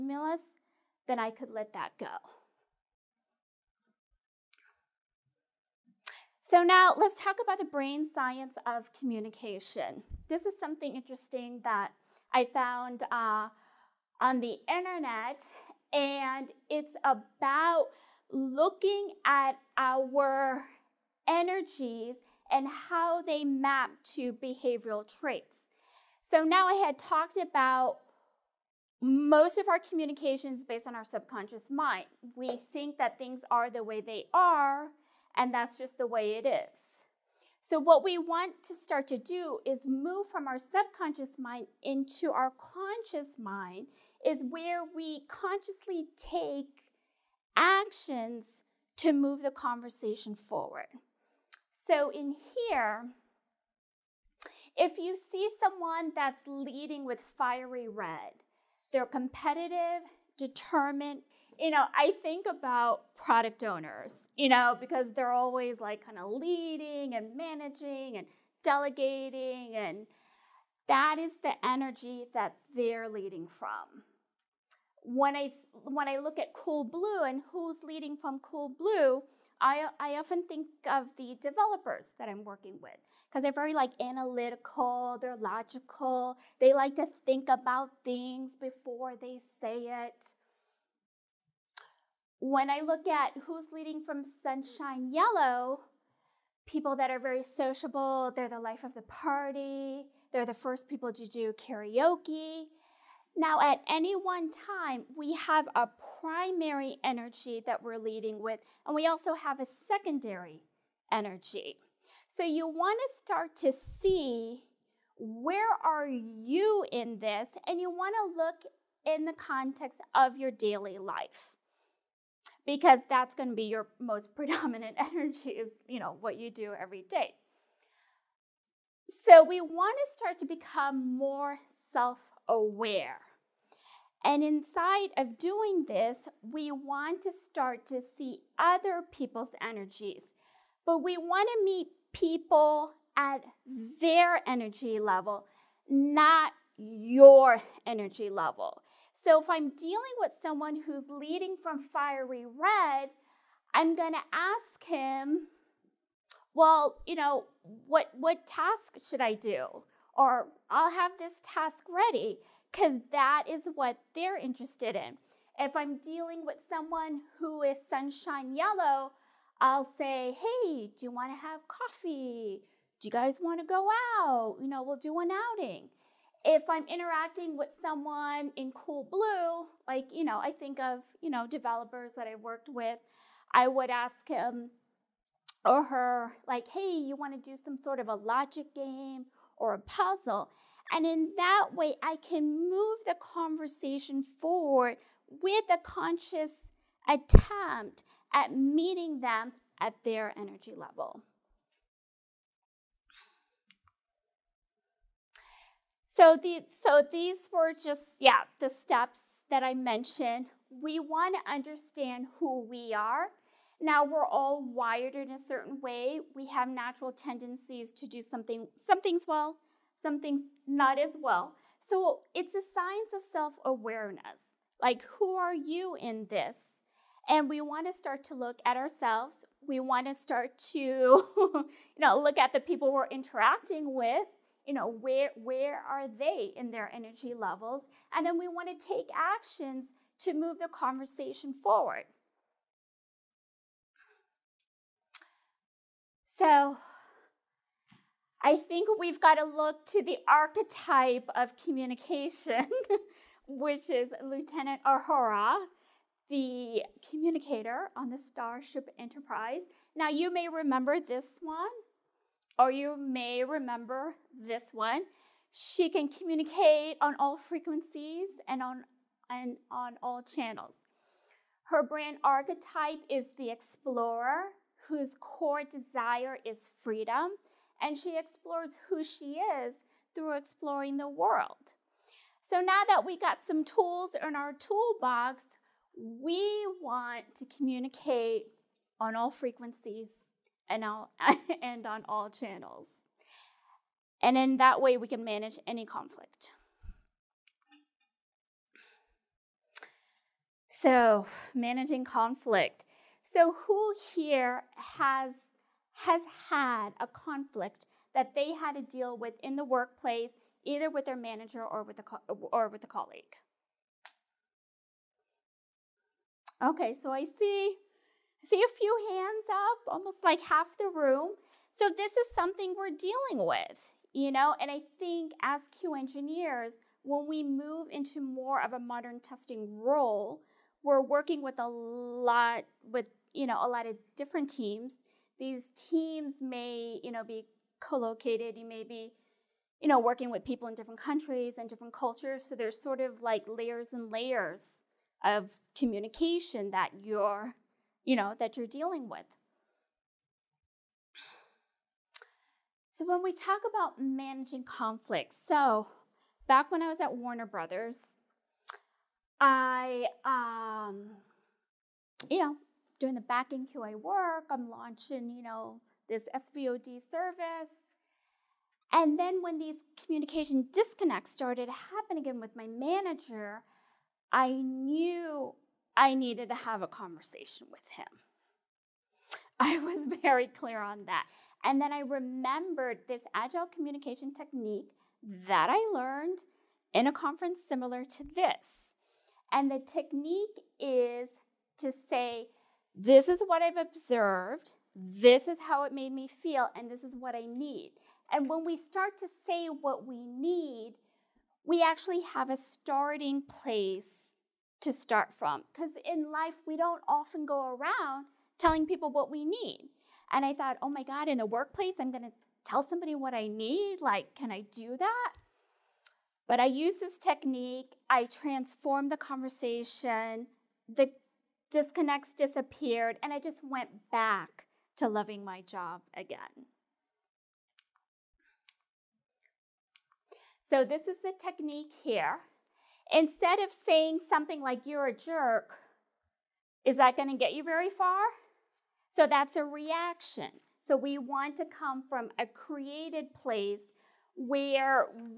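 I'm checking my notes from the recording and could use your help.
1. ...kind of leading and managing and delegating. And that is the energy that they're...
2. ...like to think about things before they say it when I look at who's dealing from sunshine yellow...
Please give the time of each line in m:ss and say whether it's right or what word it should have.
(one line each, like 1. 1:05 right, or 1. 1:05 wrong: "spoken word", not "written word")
1. 1:06 right
2. 1:26 wrong: "leading", not "dealing".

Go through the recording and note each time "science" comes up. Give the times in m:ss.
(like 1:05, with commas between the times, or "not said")
0:08, 3:42.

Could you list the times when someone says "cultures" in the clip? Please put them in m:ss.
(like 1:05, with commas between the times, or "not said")
5:41.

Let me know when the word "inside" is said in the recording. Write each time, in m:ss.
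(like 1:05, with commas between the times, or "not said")
2:14.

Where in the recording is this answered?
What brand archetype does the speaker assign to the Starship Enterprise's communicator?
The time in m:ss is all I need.
4:33.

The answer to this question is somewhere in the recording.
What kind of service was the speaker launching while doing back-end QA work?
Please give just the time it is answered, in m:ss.
6:06.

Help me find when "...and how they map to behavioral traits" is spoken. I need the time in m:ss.
0:22.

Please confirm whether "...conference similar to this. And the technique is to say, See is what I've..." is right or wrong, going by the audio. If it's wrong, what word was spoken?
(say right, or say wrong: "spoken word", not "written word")
wrong: "This", not "See".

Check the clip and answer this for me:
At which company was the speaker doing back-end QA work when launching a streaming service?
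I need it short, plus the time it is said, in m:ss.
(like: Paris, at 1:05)
Warner Brothers, at 5:57.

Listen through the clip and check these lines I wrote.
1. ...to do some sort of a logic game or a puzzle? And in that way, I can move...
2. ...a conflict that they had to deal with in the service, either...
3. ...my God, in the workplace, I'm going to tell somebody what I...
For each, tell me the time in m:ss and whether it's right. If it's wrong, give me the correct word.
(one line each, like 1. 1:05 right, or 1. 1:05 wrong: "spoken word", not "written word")
1. 3:07 right
2. 5:06 wrong: "workplace", not "service"
3. 6:50 right.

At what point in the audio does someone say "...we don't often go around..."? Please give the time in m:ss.
6:46.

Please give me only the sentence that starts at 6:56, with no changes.
But I use this technique, I transform the conversation, the disconnects disappeared, and I just went back to loving my job again.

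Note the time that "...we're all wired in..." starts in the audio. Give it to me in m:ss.
3:34.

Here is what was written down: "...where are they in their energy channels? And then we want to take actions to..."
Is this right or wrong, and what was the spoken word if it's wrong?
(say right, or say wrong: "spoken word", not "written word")
wrong: "levels", not "channels".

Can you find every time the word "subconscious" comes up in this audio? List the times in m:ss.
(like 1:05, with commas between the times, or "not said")
0:31, 0:40.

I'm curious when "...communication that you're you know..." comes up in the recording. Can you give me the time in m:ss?
5:45.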